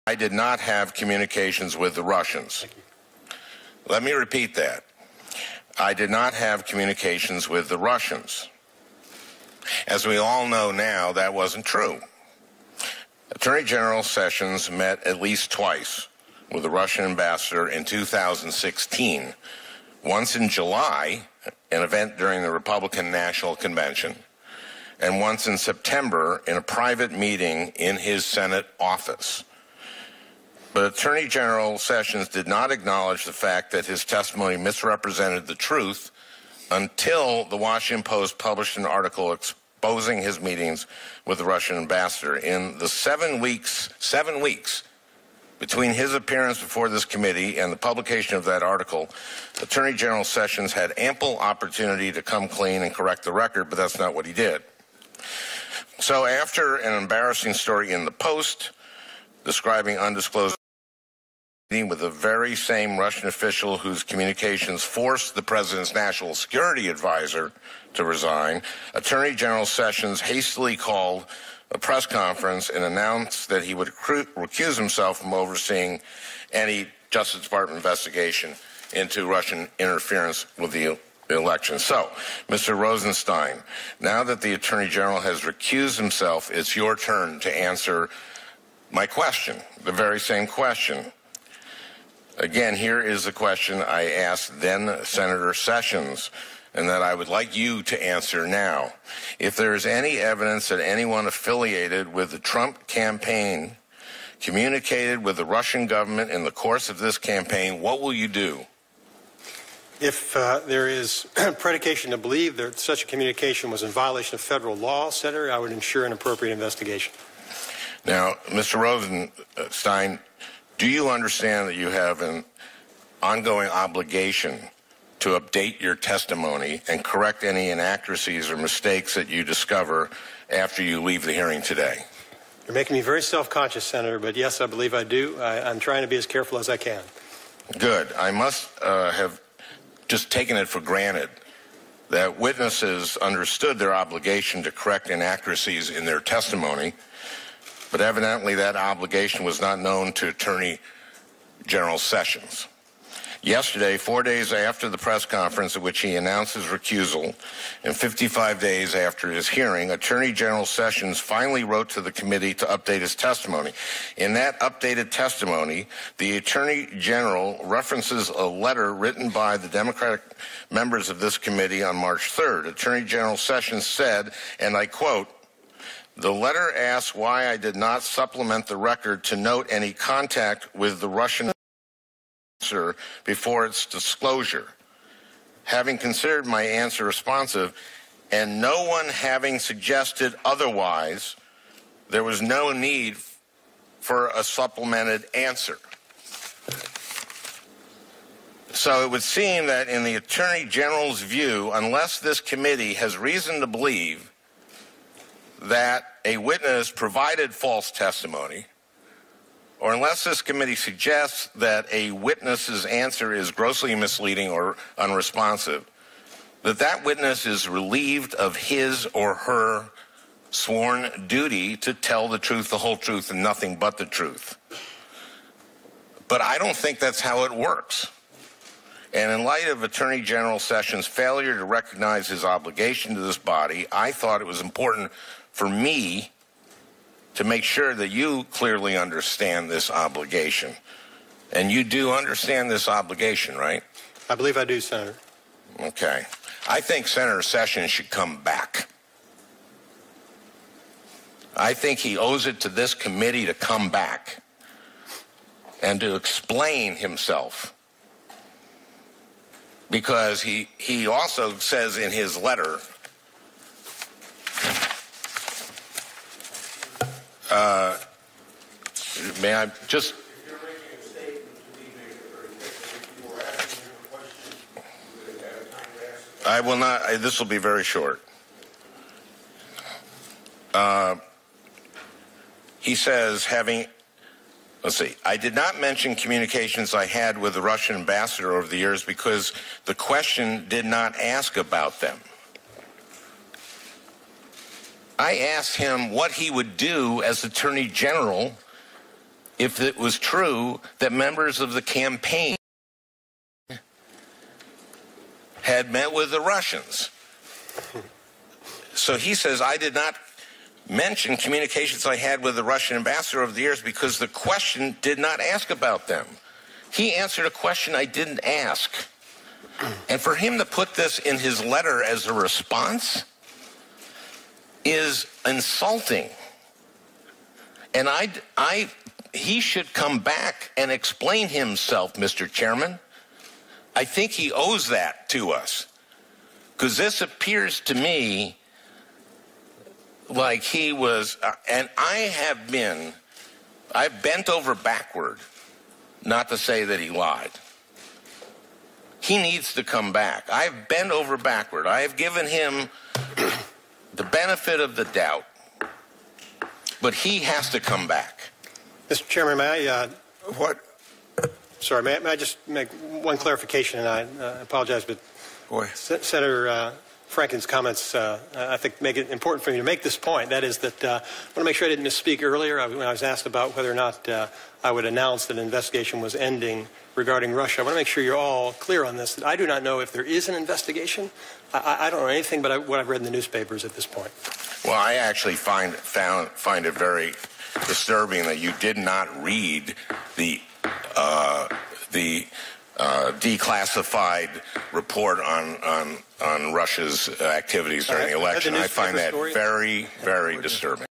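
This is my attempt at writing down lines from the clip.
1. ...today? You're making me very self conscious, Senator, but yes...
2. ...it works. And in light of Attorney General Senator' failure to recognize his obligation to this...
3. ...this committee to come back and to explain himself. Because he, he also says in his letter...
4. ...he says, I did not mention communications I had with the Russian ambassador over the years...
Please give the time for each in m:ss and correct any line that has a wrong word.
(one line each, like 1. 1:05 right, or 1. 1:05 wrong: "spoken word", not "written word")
1. 2:11 right
2. 3:47 wrong: "Sessions", not "Senator"
3. 4:12 right
4. 5:09 right.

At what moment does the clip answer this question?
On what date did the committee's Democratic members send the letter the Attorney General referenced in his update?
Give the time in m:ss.
2:51.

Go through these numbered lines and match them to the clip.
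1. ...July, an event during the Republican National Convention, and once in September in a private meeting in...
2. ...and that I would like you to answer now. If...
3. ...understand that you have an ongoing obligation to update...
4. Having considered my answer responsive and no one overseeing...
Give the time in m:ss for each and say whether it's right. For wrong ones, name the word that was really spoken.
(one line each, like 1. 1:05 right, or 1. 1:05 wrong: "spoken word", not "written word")
1. 0:20 right
2. 1:36 right
3. 2:01 right
4. 3:05 wrong: "having", not "overseeing".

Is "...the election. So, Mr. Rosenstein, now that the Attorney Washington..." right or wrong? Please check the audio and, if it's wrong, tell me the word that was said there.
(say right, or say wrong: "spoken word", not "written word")
wrong: "General", not "Washington".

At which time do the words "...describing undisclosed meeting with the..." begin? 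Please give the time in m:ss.
0:59.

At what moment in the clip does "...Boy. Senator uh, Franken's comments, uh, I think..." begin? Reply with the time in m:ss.
6:05.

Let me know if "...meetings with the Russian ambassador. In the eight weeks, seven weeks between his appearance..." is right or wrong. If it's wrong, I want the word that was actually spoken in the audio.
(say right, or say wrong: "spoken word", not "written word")
wrong: "seven", not "eight".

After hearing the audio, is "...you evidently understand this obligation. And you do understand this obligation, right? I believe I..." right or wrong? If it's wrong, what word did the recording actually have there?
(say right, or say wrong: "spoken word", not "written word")
wrong: "clearly", not "evidently".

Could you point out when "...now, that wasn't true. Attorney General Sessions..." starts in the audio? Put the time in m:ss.
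0:10.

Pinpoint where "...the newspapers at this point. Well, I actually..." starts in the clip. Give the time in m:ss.
6:23.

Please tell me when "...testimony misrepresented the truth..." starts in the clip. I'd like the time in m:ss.
0:34.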